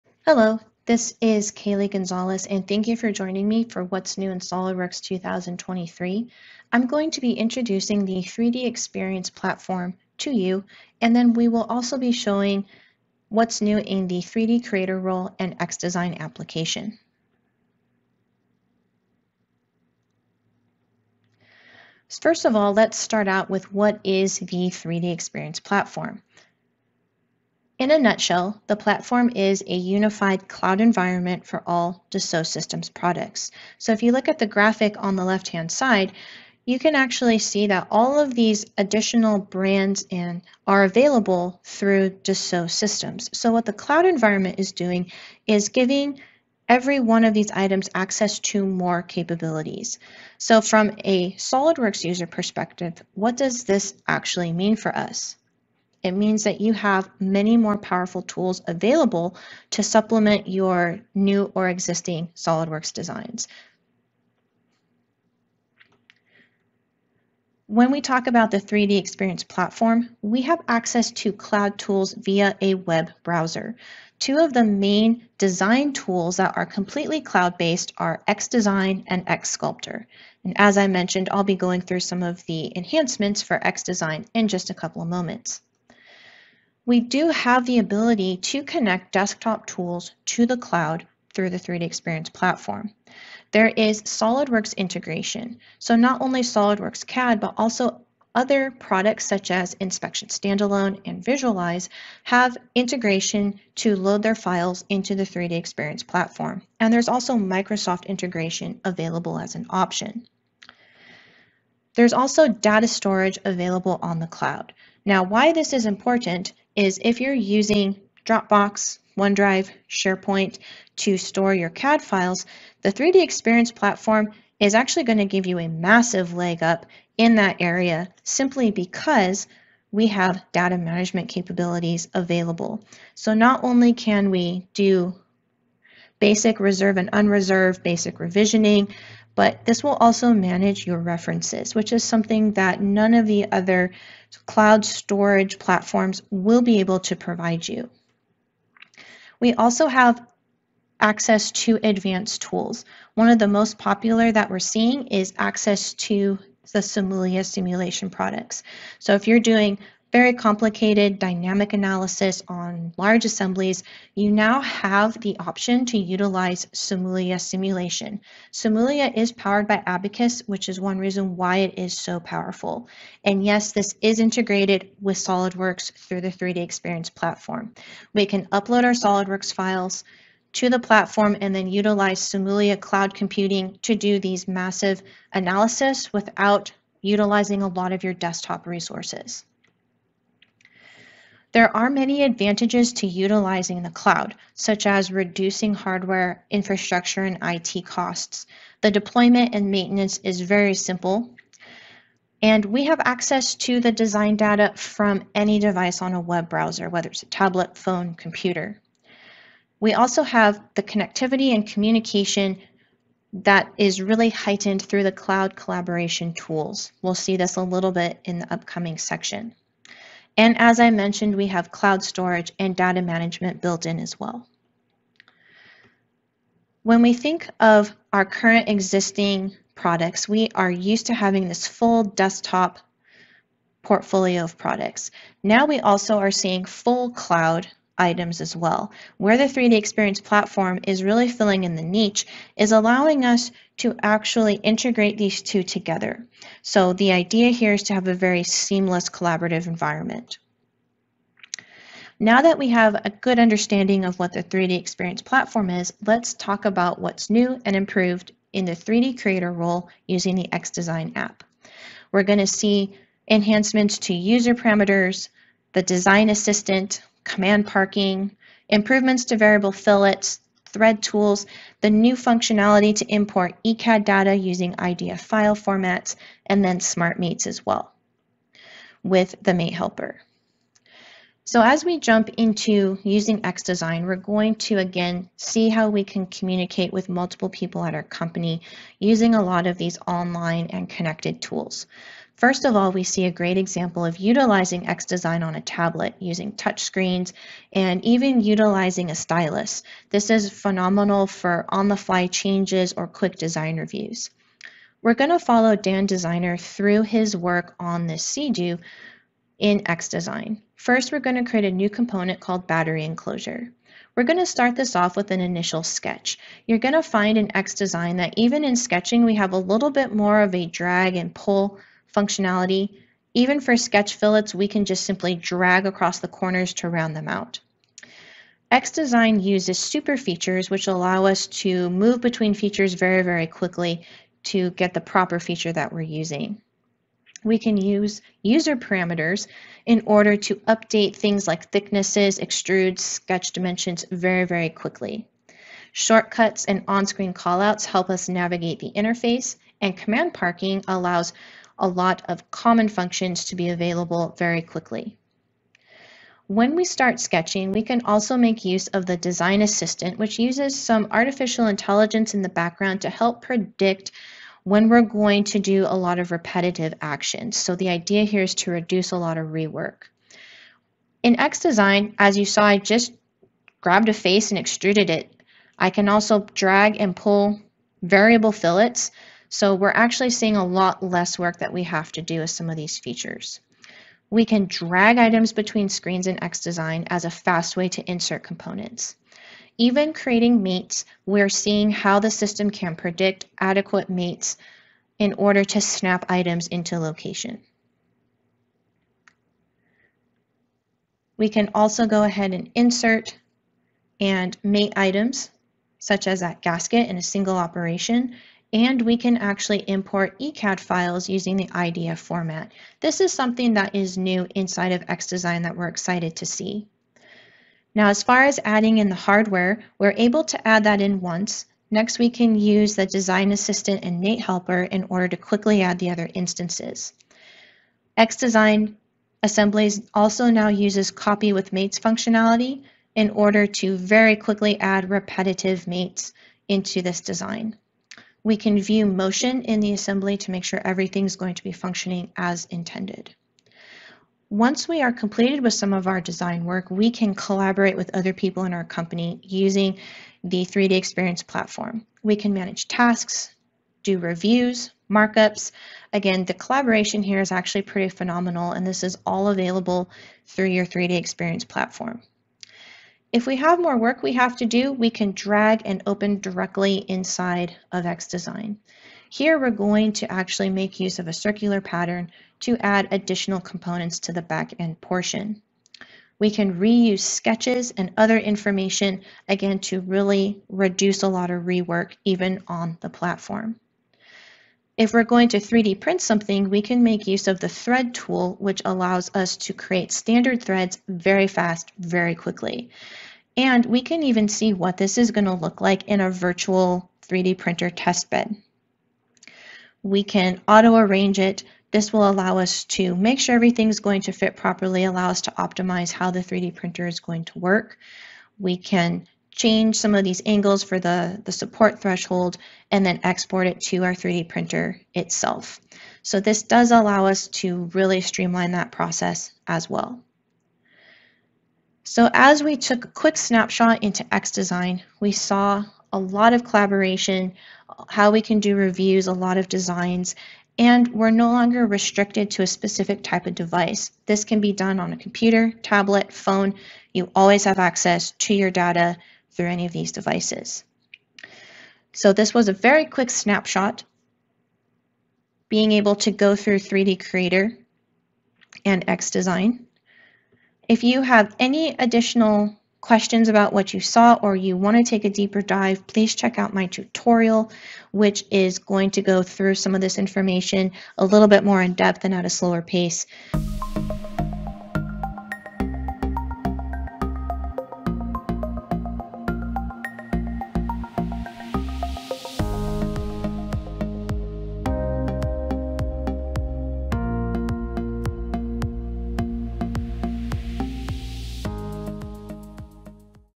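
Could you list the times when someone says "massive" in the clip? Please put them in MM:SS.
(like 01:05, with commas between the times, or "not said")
02:05, 03:04.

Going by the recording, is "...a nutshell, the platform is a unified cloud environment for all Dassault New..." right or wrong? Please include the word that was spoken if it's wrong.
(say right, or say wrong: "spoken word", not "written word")
wrong: "Systems", not "New".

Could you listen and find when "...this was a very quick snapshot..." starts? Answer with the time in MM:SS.
09:02.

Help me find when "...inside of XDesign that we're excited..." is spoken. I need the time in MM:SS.
06:54.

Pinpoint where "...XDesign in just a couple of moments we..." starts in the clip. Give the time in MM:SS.
01:23.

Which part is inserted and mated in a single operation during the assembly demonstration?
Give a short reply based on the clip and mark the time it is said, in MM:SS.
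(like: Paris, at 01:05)
gasket, at 06:46.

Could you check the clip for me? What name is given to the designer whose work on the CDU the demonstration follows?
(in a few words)
Dan Designer.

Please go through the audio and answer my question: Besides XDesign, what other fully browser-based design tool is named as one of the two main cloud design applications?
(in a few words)
XSculptor.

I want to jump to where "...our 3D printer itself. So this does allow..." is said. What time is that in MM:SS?
08:34.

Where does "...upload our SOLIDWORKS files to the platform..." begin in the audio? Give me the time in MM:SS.
02:58.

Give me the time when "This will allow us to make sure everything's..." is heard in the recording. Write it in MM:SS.
08:21.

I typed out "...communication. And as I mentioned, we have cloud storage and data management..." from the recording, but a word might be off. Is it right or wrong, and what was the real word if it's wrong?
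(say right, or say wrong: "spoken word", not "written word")
wrong: "section", not "communication".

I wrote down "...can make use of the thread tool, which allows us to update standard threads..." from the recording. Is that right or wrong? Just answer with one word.
wrong.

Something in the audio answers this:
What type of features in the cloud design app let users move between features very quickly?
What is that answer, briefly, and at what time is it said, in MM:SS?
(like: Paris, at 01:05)
super features, at 05:29.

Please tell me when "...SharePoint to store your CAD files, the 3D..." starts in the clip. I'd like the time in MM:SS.
01:59.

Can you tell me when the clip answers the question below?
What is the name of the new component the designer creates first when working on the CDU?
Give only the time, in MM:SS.
05:12.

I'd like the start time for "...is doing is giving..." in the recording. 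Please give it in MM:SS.
00:44.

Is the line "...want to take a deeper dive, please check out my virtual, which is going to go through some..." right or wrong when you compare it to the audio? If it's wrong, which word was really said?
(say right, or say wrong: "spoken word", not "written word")
wrong: "tutorial", not "virtual".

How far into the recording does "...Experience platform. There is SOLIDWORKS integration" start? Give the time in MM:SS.
01:31.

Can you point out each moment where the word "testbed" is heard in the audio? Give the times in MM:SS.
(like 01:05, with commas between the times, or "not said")
08:17.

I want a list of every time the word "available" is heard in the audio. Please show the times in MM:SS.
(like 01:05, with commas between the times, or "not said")
00:40, 00:58, 01:48, 01:53, 02:12, 05:53, 07:39.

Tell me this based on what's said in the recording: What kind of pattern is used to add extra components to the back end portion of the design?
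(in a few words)
circular pattern.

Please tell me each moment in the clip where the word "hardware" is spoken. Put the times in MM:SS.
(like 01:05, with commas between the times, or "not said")
03:15, 06:59.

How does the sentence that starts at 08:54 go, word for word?
This can be done on a computer, tablet, phone.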